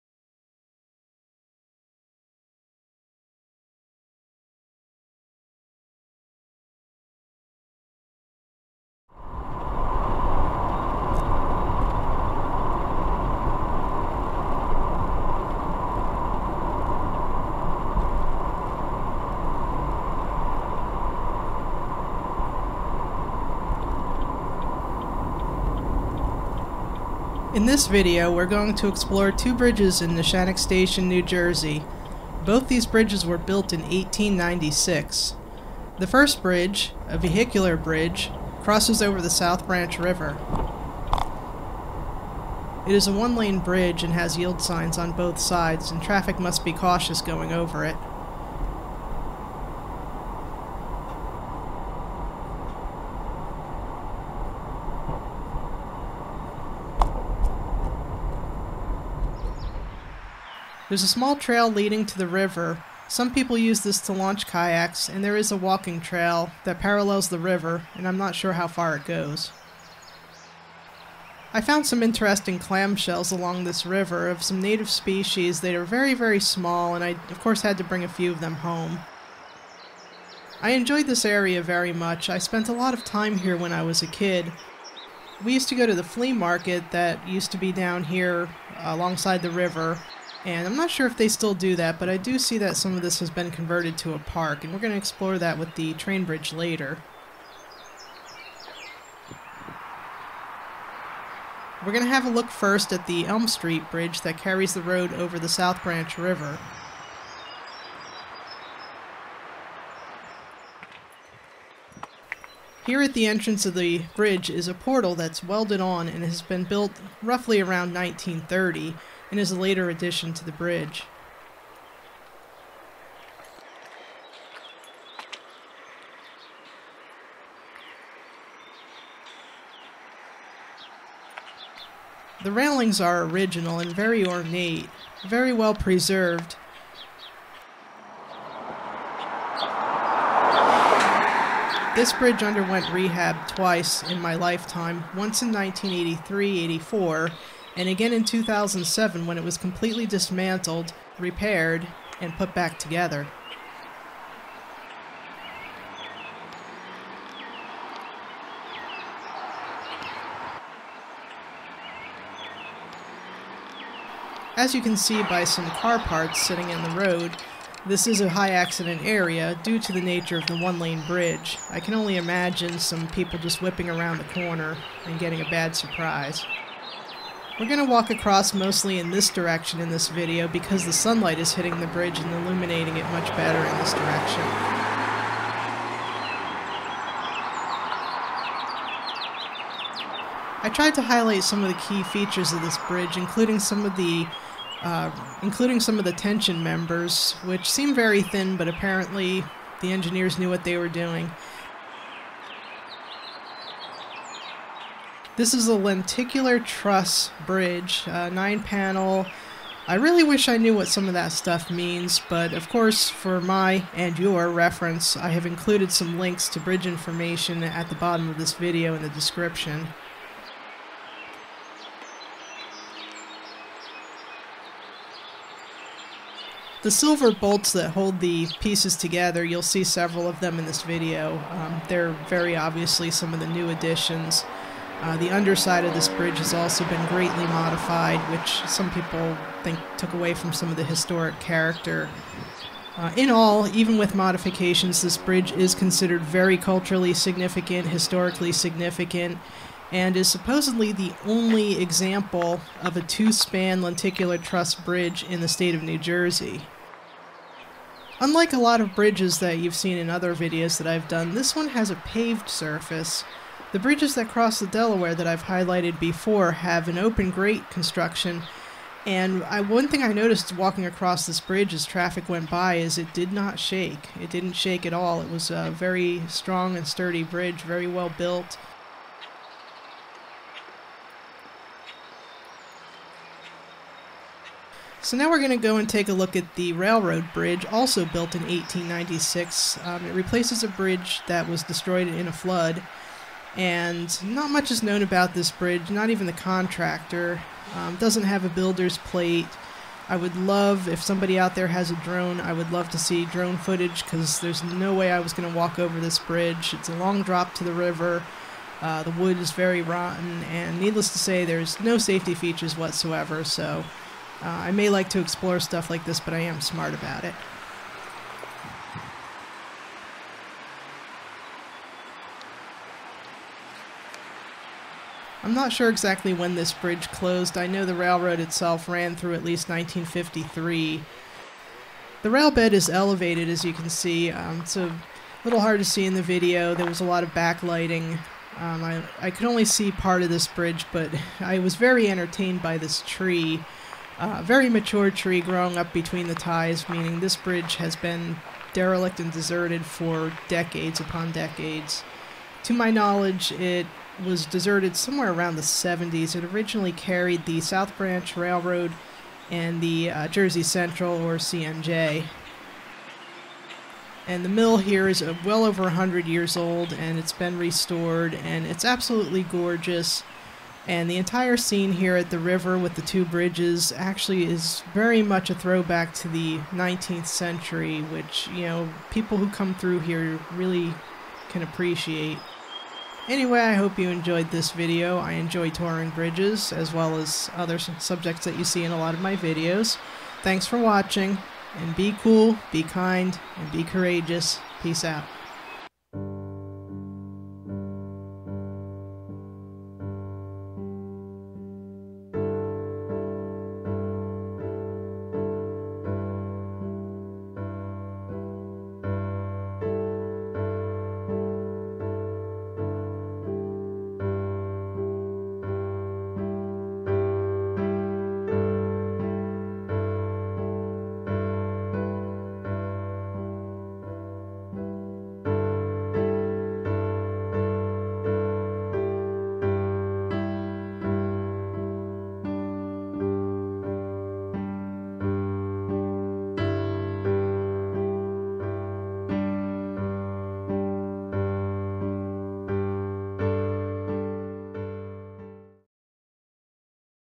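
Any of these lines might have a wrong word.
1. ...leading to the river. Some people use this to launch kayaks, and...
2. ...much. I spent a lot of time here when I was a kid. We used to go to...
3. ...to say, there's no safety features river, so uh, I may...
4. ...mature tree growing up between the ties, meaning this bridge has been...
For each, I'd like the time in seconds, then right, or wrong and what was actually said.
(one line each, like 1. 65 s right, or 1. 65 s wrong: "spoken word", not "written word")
1. 61 s right
2. 81 s right
3. 311 s wrong: "whatsoever", not "river"
4. 344 s right.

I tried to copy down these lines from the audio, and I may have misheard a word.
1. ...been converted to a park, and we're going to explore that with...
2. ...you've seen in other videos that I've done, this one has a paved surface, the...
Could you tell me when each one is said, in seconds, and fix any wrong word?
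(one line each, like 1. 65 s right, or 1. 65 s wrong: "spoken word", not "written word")
1. 93 s right
2. 259 s right.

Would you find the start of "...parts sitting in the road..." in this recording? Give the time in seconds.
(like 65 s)
165 s.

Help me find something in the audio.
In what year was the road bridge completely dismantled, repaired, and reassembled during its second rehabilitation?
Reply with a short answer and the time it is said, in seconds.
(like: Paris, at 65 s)
2007, at 148 s.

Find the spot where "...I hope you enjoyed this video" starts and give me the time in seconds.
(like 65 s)
383 s.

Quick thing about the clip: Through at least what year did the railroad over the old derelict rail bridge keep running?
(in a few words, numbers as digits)
1953.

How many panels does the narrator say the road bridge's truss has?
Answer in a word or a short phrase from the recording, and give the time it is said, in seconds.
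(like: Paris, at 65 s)
9, at 208 s.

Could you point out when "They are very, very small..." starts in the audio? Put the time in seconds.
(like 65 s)
75 s.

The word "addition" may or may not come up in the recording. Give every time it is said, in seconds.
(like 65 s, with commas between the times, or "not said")
119 s, 233 s.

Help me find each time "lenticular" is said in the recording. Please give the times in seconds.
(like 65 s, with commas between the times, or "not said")
205 s, 253 s.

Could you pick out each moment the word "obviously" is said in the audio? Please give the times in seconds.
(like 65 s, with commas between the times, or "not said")
232 s.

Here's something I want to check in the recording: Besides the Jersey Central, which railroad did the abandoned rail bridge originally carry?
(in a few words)
South Branch Railroad.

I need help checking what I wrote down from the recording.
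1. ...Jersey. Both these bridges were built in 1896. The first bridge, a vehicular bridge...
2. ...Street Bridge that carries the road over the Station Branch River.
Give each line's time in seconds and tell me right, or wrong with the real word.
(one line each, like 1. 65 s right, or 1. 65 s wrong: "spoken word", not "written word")
1. 31 s right
2. 103 s wrong: "South", not "Station".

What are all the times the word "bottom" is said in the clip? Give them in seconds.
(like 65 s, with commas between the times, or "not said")
217 s.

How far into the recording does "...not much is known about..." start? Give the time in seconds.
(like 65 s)
294 s.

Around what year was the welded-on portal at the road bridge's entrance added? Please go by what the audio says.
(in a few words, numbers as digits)
1930.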